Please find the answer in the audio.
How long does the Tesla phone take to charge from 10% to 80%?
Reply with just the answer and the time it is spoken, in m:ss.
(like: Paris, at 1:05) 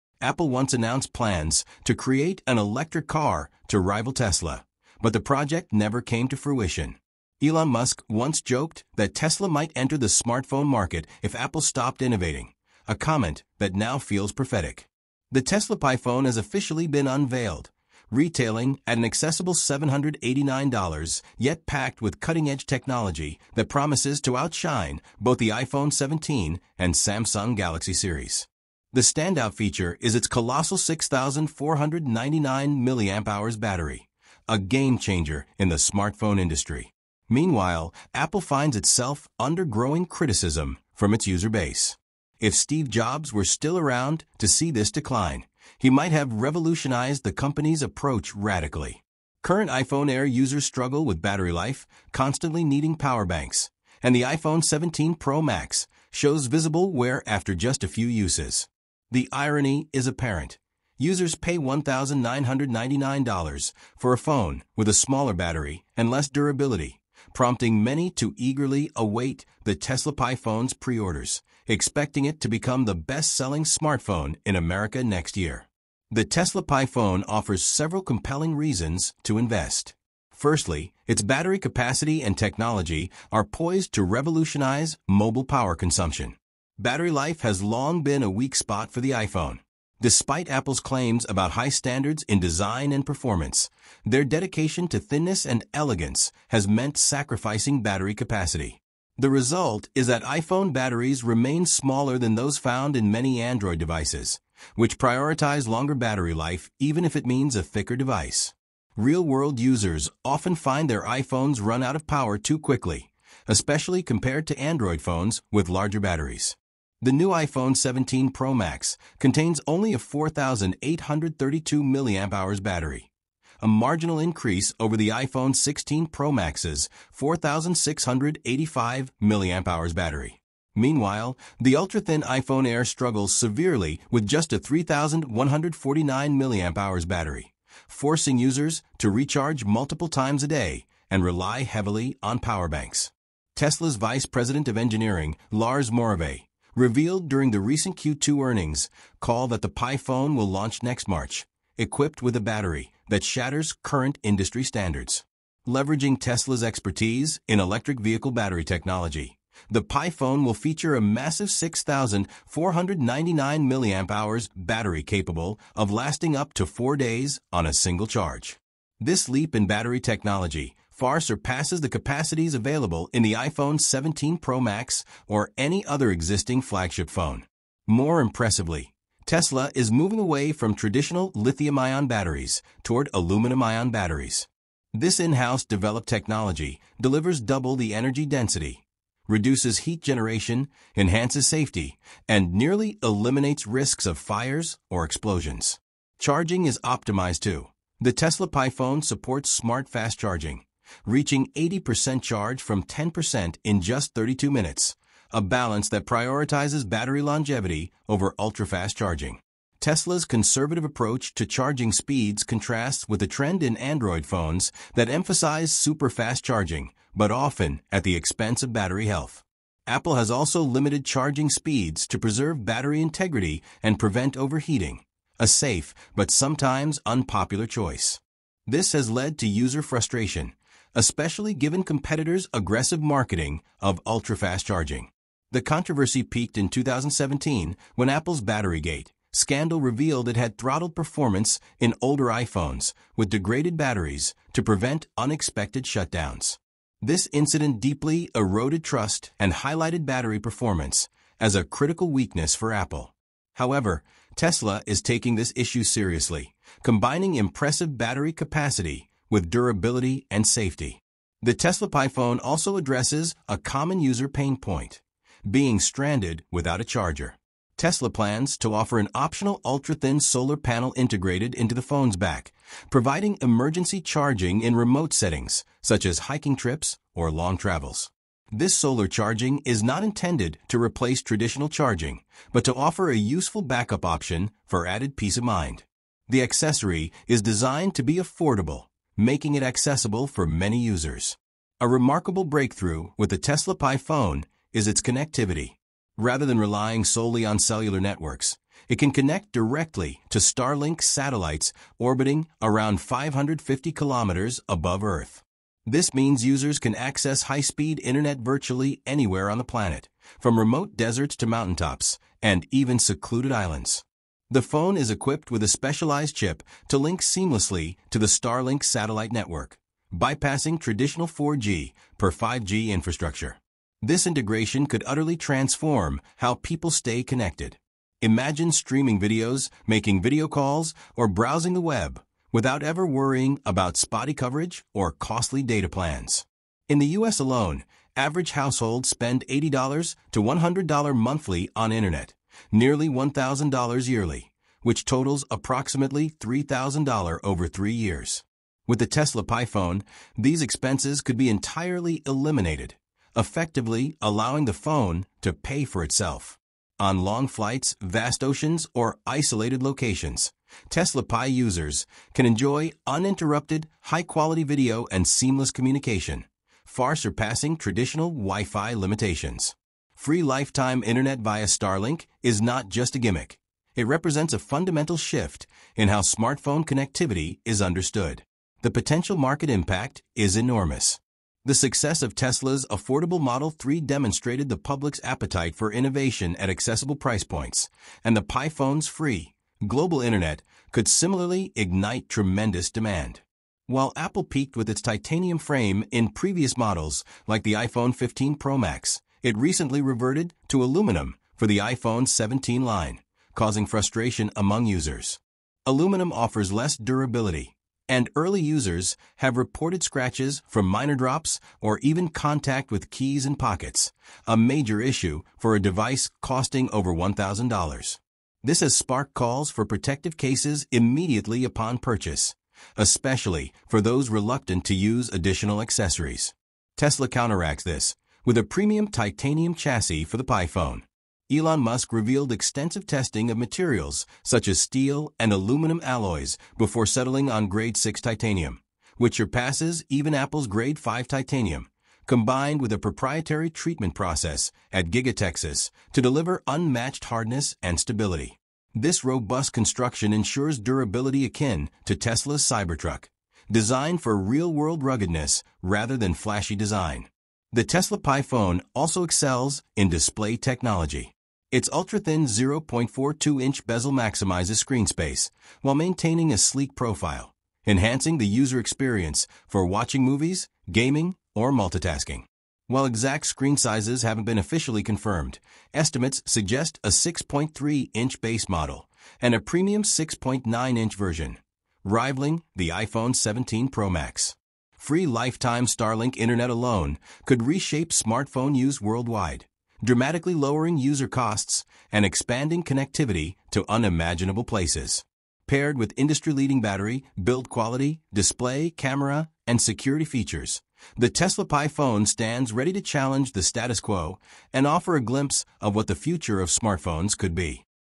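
32 minutes, at 3:24.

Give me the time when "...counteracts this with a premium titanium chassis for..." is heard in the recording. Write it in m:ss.
7:07.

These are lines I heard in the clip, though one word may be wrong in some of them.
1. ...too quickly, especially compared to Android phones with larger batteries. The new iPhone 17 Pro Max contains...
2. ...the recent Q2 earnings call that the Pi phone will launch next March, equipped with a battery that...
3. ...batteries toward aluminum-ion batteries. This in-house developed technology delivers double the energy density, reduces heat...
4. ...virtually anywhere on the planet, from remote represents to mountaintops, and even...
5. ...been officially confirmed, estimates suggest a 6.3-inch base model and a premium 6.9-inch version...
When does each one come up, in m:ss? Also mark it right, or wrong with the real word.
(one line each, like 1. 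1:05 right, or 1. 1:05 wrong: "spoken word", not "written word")
1. 1:52 right
2. 2:27 right
3. 3:02 right
4. 5:08 wrong: "deserts", not "represents"
5. 7:54 right.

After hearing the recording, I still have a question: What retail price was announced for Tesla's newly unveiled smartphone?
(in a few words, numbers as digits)
$789.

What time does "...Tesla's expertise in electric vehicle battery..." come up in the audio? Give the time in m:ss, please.
2:36.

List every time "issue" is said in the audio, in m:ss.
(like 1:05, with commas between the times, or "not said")
4:15, 6:55.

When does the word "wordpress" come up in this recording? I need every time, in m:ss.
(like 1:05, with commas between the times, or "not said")
not said.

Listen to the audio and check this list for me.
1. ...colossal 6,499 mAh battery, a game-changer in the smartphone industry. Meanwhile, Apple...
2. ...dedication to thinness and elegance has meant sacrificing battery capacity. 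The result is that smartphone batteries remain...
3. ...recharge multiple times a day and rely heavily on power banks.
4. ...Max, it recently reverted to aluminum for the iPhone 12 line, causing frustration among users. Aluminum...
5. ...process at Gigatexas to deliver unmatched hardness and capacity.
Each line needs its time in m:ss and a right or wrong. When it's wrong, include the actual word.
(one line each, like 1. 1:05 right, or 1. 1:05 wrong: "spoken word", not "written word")
1. 0:30 right
2. 1:34 wrong: "iPhone", not "smartphone"
3. 2:19 right
4. 6:38 wrong: "17", not "12"
5. 7:24 wrong: "stability", not "capacity".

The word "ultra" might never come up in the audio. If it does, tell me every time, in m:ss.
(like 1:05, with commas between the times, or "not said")
2:11, 3:28, 3:54, 4:29, 7:41.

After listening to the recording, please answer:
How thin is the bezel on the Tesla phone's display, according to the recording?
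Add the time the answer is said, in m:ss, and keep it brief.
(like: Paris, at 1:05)
0.42 inch, at 7:42.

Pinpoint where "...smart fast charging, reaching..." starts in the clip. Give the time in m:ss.
3:19.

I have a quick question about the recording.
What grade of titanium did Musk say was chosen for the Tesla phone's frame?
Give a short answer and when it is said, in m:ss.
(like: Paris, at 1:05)
grade 6, at 7:17.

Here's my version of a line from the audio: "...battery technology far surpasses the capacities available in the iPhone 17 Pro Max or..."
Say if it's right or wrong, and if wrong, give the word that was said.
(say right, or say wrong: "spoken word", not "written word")
right.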